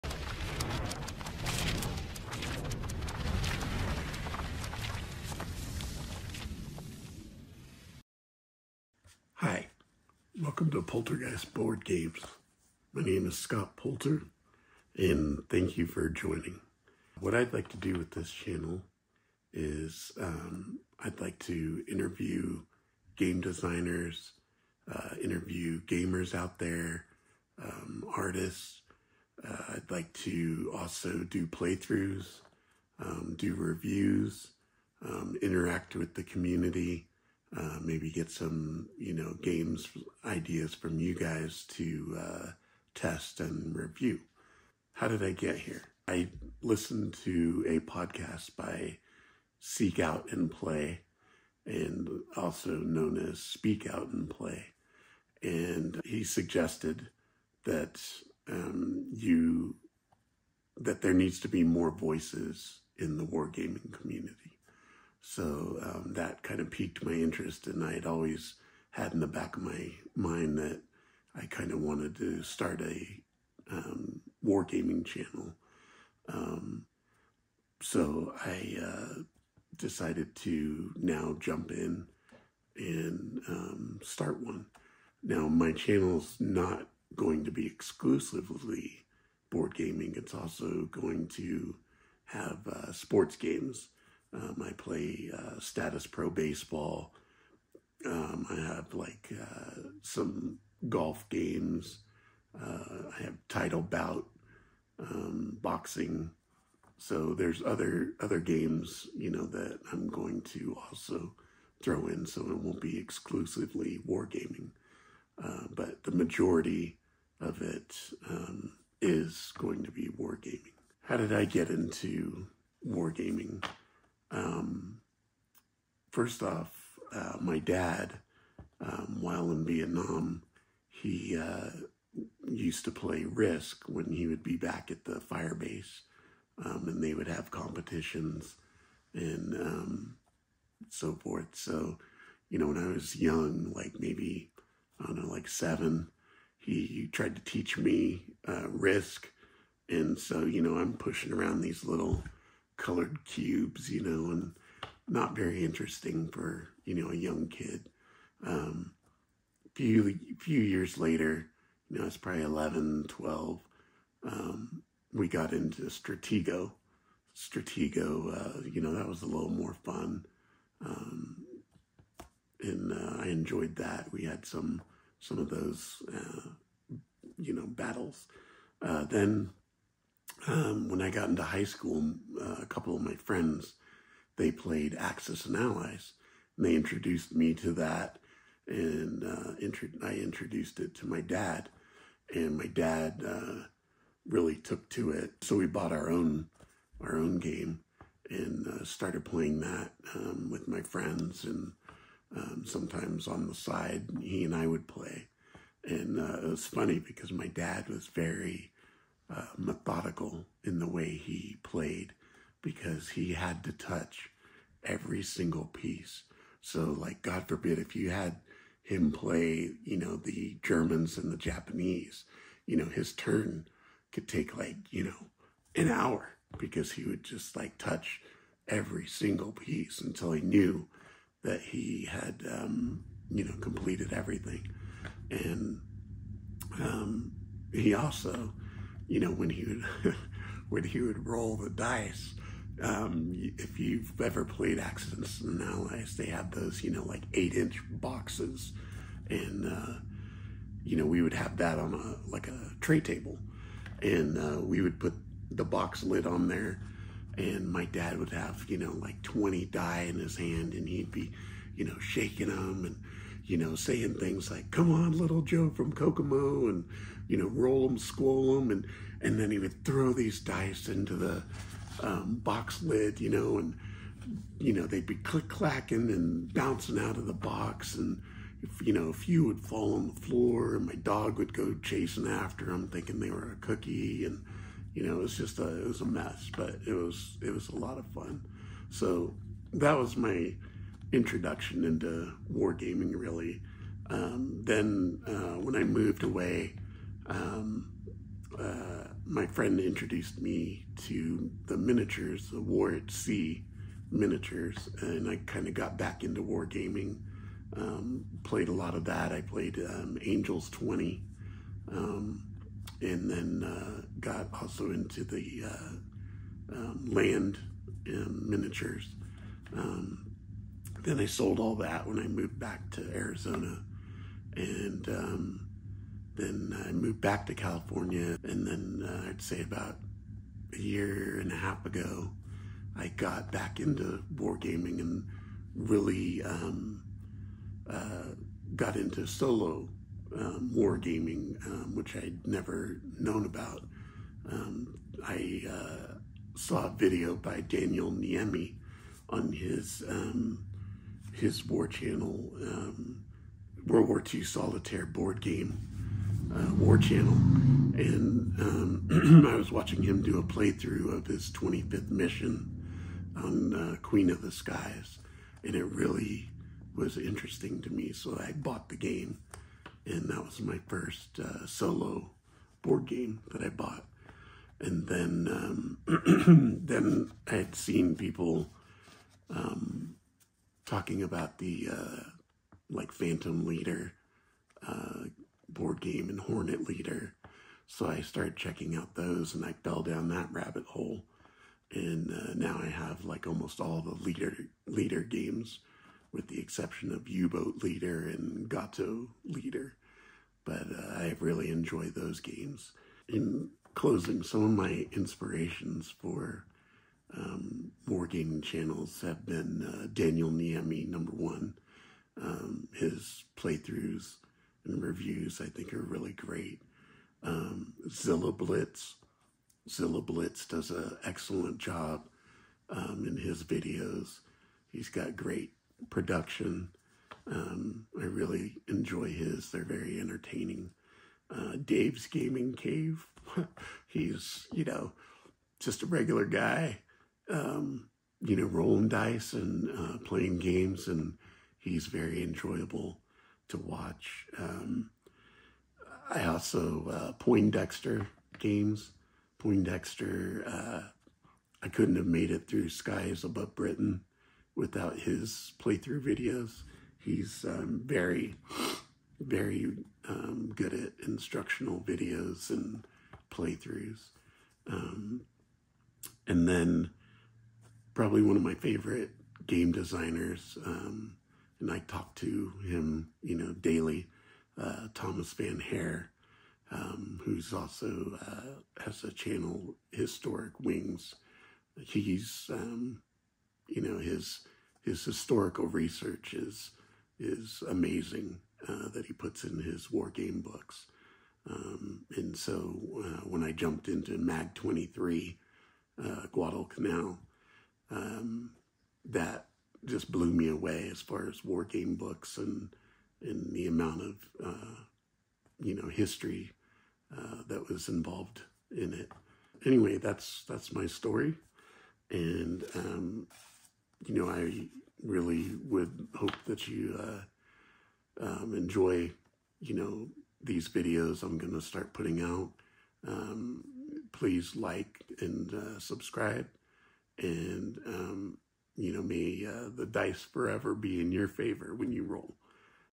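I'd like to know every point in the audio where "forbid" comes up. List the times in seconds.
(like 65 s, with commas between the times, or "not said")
217 s.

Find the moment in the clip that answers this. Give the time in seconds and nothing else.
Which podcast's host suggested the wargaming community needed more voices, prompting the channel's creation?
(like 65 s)
49 s.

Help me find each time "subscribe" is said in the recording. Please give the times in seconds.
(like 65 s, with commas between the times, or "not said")
525 s.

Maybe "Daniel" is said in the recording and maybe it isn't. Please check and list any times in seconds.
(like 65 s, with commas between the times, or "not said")
347 s, 410 s.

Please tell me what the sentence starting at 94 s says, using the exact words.
Um, I play uh, Statis Pro baseball.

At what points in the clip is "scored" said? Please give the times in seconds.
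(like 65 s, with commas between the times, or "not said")
not said.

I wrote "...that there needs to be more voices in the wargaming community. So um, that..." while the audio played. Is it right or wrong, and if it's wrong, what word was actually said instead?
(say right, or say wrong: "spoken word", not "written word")
right.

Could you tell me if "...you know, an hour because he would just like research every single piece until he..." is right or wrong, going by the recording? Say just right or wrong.
wrong.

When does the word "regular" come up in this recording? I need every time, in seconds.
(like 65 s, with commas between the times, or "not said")
436 s.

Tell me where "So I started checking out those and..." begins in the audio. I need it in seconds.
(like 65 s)
387 s.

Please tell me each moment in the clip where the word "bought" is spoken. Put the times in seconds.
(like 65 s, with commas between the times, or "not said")
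195 s, 368 s, 373 s.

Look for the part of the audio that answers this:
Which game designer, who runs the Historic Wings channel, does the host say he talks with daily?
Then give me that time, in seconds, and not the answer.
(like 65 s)
475 s.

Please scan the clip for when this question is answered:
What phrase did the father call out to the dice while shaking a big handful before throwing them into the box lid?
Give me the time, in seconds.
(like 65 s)
265 s.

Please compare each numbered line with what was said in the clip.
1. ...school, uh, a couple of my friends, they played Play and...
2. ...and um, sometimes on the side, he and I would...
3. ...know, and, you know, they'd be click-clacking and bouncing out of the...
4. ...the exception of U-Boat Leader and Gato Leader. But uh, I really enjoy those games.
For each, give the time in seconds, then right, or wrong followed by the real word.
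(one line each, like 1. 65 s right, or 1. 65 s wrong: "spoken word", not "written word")
1. 181 s wrong: "Axis", not "Play"
2. 201 s right
3. 273 s right
4. 396 s right.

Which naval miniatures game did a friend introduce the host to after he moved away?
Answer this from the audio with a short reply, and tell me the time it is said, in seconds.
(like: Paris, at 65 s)
War at Sea, at 302 s.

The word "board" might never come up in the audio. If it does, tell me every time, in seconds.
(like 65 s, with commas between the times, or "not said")
11 s, 89 s, 355 s, 372 s, 385 s.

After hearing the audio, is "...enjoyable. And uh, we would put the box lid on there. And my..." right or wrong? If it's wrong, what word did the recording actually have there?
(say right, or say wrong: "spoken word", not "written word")
wrong: "table", not "enjoyable".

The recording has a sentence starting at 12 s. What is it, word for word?
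My name is Scott Poulter, and thank you for joining.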